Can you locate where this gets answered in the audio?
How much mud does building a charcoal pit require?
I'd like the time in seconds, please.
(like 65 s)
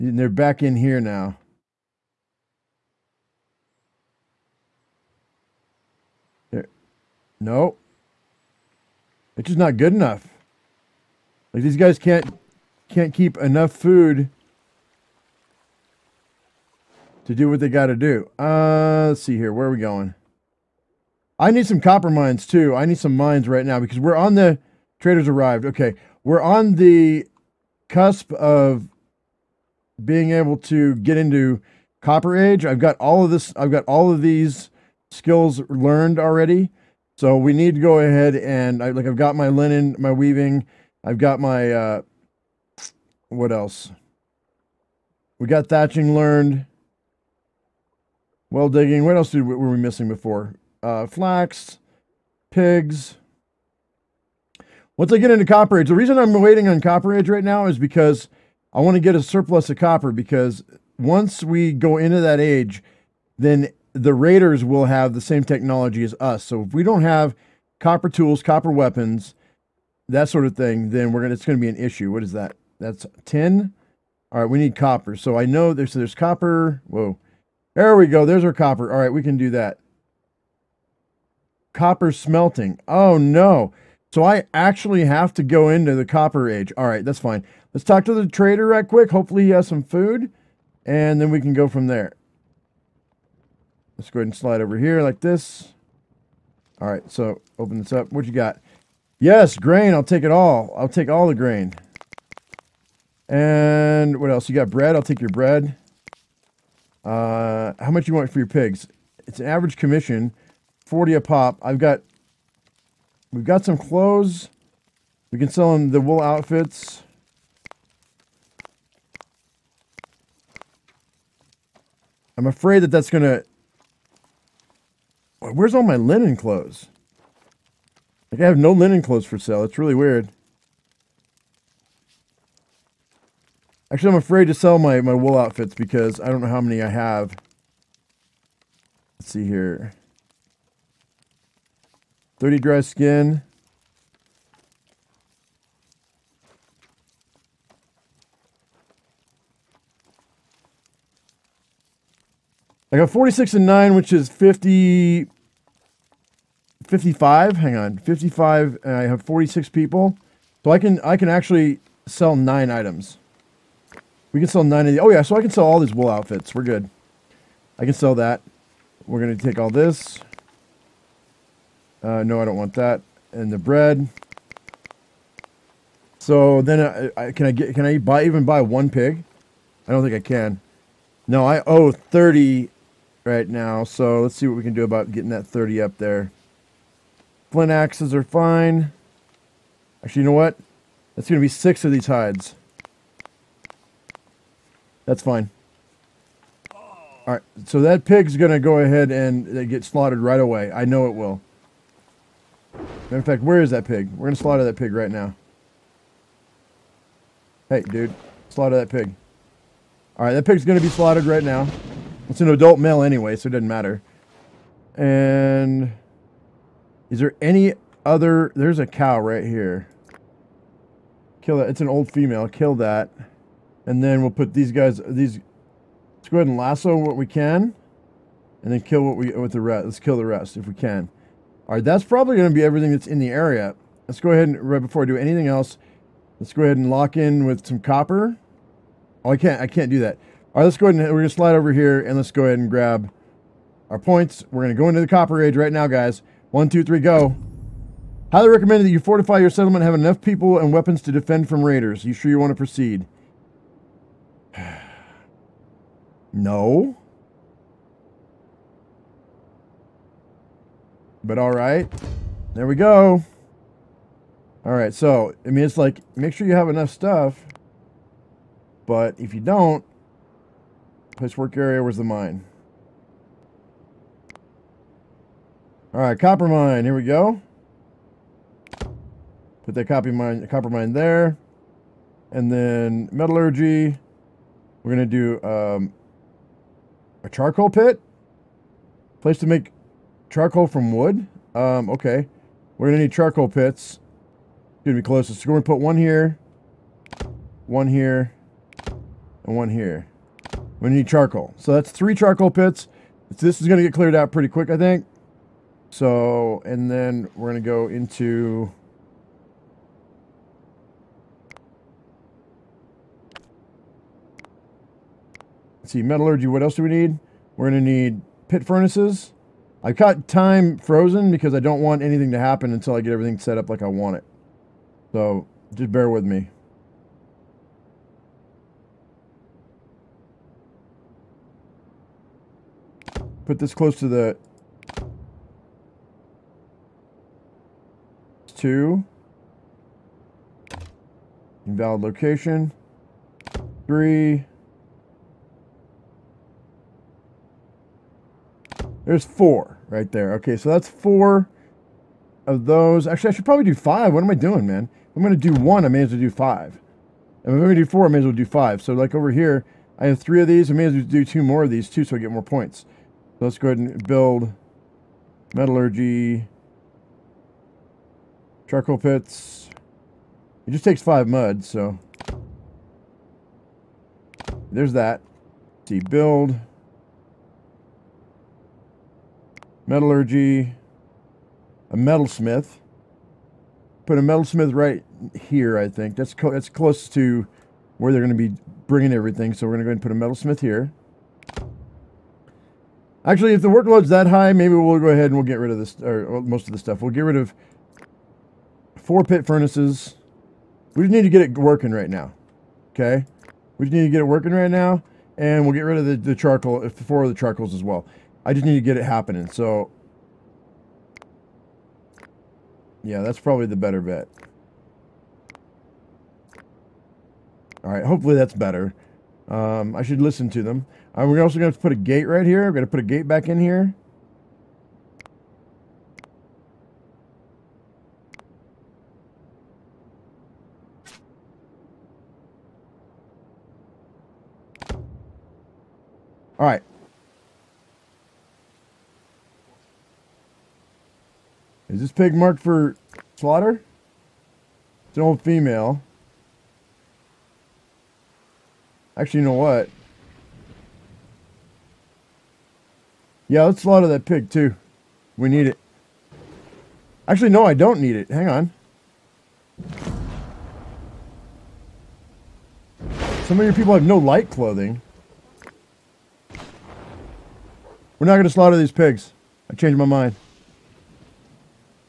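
371 s.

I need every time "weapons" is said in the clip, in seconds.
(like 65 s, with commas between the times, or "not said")
68 s, 250 s.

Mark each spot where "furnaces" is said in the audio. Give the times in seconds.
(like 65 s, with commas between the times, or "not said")
318 s, 399 s.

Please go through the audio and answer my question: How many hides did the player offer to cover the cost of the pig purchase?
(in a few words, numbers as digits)
6.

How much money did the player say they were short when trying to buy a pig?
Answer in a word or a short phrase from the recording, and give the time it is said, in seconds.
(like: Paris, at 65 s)
30, at 181 s.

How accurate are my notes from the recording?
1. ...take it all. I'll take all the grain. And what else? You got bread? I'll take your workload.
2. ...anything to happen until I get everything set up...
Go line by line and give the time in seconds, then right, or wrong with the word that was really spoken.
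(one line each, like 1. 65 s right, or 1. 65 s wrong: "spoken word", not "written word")
1. 100 s wrong: "bread", not "workload"
2. 322 s right.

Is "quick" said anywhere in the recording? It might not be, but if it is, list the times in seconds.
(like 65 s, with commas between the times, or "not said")
88 s, 304 s.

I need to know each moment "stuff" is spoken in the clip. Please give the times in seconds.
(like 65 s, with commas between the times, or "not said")
266 s, 396 s.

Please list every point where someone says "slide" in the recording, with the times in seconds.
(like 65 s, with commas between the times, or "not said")
94 s, 241 s.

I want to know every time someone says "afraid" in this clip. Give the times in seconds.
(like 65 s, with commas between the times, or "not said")
122 s, 134 s.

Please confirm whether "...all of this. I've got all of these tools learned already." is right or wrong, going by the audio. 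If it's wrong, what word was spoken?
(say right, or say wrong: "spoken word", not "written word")
wrong: "skills", not "tools".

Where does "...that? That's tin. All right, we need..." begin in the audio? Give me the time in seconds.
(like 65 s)
72 s.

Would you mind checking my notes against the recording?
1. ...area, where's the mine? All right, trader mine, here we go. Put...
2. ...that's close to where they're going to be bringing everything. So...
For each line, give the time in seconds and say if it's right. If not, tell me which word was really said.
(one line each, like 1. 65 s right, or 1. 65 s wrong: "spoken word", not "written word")
1. 271 s wrong: "copper", not "trader"
2. 386 s right.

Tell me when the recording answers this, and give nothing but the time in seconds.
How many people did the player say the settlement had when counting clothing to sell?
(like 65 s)
158 s.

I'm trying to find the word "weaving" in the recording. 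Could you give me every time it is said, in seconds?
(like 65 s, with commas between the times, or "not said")
40 s.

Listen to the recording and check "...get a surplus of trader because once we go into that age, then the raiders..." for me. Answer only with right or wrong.
wrong.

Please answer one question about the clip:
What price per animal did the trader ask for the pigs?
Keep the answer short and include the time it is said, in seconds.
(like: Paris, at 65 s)
40, at 110 s.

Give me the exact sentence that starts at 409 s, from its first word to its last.
So, yeah, that's probably the better bet.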